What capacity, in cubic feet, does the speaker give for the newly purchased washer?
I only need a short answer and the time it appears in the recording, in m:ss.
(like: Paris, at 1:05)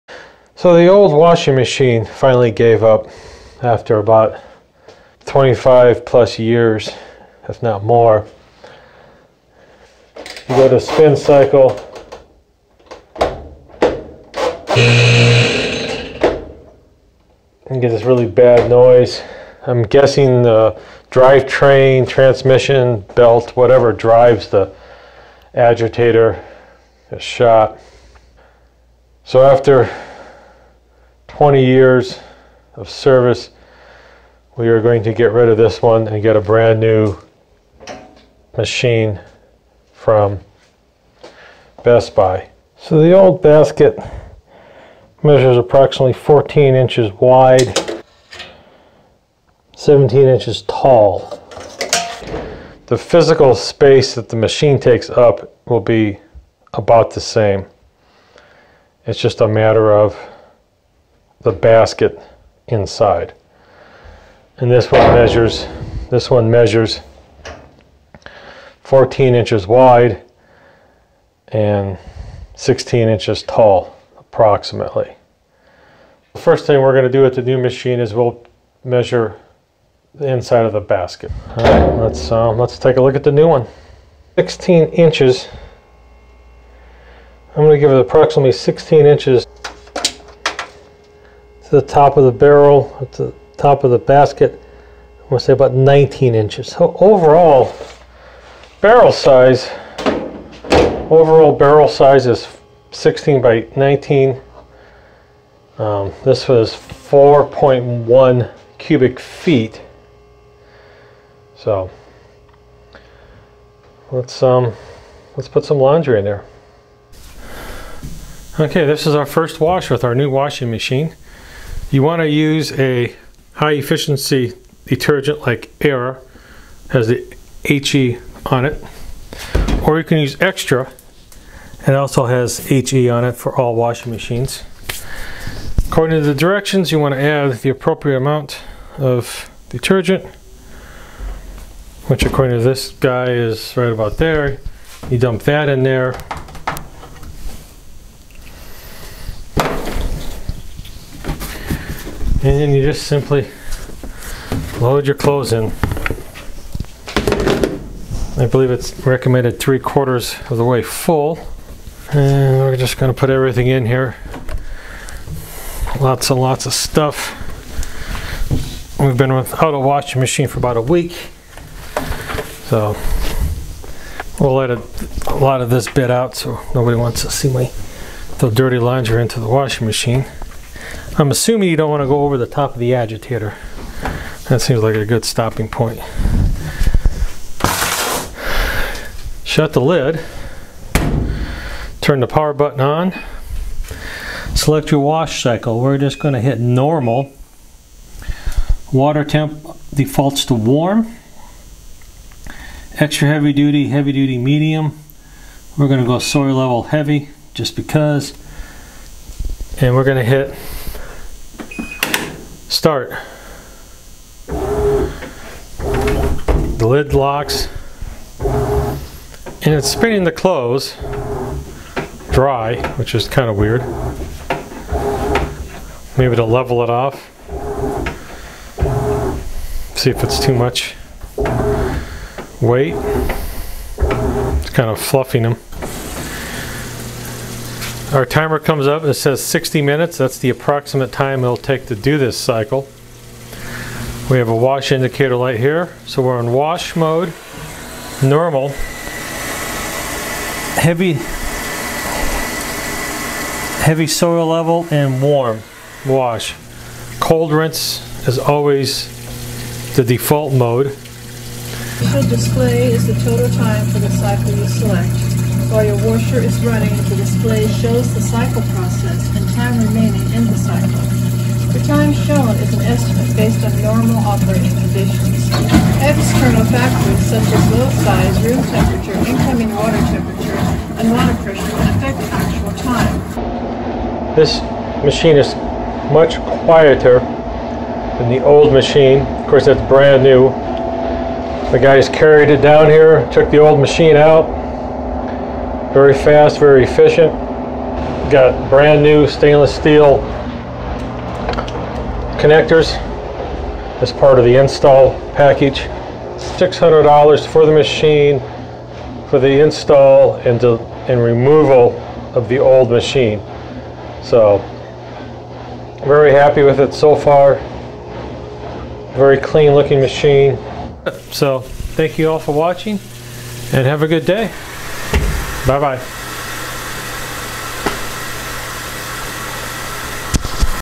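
4.1 cubic feet, at 1:46.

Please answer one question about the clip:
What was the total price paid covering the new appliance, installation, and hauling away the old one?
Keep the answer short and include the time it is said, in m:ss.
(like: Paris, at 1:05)
$600, at 5:06.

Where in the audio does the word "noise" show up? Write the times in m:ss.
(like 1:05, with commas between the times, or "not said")
0:18.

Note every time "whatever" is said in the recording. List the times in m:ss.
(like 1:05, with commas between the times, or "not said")
0:23.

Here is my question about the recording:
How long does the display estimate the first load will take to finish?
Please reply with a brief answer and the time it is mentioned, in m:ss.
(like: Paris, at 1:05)
60 minutes, at 3:59.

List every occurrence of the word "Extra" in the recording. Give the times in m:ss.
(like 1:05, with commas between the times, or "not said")
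3:22.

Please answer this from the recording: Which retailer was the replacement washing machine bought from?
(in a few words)
Best Buy.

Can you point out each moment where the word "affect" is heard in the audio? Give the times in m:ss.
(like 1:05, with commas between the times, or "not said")
4:41.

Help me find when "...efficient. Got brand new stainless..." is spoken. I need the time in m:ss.
4:56.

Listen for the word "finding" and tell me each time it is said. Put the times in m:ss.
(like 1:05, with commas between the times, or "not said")
not said.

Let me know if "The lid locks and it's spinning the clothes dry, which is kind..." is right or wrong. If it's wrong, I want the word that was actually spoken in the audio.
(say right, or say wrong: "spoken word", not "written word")
right.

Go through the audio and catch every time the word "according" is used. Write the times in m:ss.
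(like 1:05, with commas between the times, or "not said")
2:15, 2:22.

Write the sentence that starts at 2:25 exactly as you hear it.
You dump that in there, and then you just simply load your clothes in.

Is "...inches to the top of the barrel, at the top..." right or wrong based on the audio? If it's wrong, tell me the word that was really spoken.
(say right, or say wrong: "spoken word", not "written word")
right.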